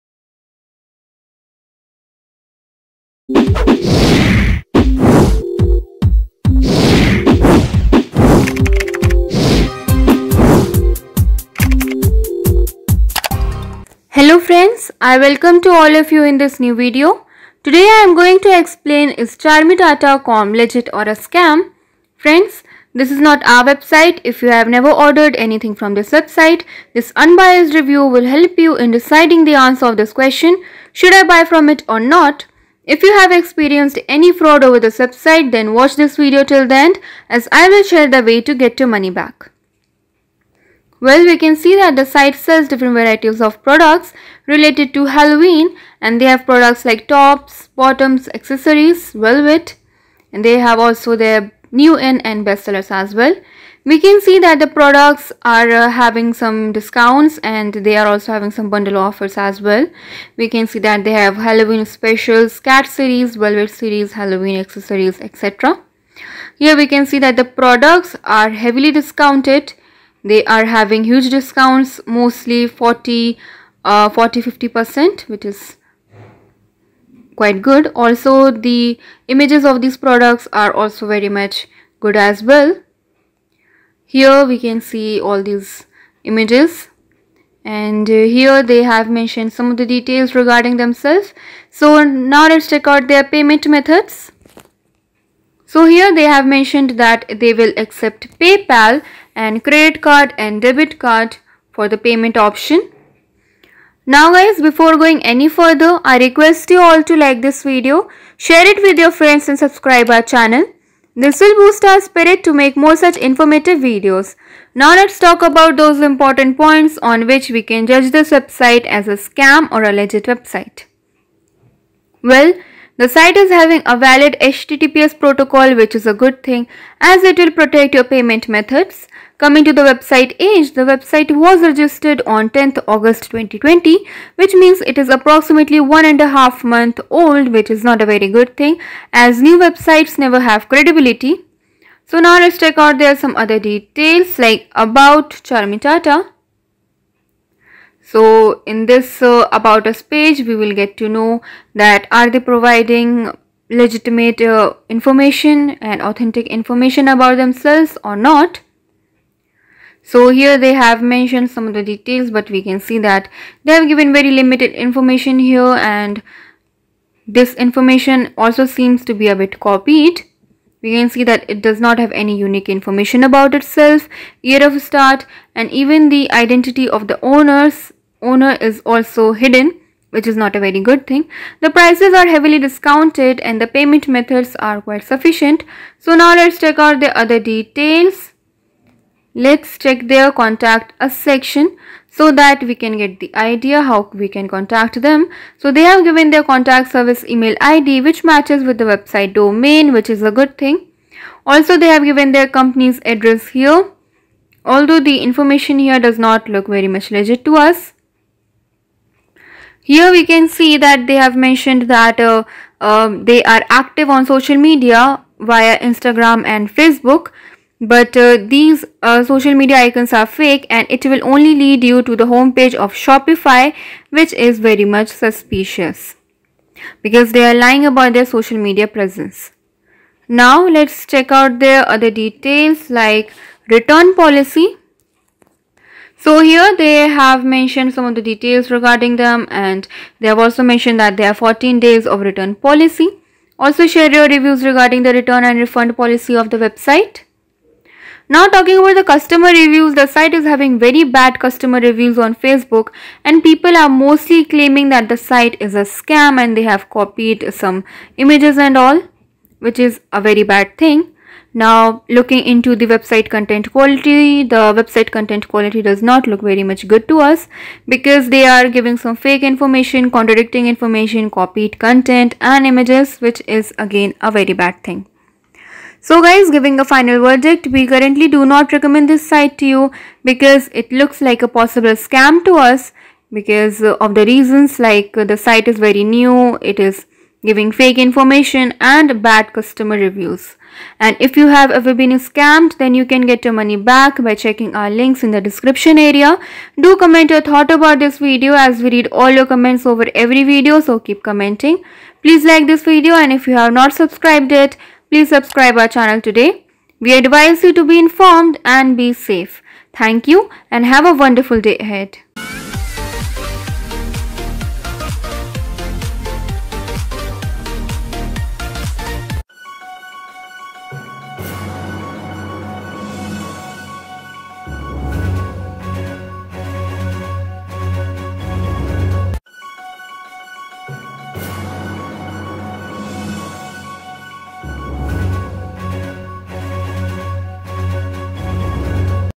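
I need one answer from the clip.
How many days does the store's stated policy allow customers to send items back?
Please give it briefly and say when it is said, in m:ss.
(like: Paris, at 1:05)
14, at 4:01.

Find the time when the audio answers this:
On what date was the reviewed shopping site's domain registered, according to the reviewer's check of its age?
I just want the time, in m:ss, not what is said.
2:12.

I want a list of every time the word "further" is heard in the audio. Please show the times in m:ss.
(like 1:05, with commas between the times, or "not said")
1:45.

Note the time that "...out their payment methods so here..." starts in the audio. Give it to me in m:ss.
1:32.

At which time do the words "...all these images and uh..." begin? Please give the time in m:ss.
1:25.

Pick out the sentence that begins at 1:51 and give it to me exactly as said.
This will boost our spirit to make more such informative videos.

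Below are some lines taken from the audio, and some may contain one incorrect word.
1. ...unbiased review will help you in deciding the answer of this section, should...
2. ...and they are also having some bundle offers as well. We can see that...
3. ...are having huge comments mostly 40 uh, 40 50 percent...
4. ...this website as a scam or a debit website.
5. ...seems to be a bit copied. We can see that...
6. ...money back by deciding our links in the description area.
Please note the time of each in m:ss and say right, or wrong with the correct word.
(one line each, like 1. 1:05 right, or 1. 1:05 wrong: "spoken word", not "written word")
1. 0:27 wrong: "question", not "section"
2. 0:57 right
3. 1:10 wrong: "discounts", not "comments"
4. 1:58 wrong: "legit", not "debit"
5. 2:48 right
6. 4:53 wrong: "checking", not "deciding".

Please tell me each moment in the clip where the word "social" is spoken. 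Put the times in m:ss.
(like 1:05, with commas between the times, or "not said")
3:34, 3:39, 3:48.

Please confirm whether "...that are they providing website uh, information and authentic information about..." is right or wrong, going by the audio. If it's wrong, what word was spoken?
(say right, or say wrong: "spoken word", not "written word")
wrong: "legitimate", not "website".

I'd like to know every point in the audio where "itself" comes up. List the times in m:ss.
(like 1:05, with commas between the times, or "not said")
2:53.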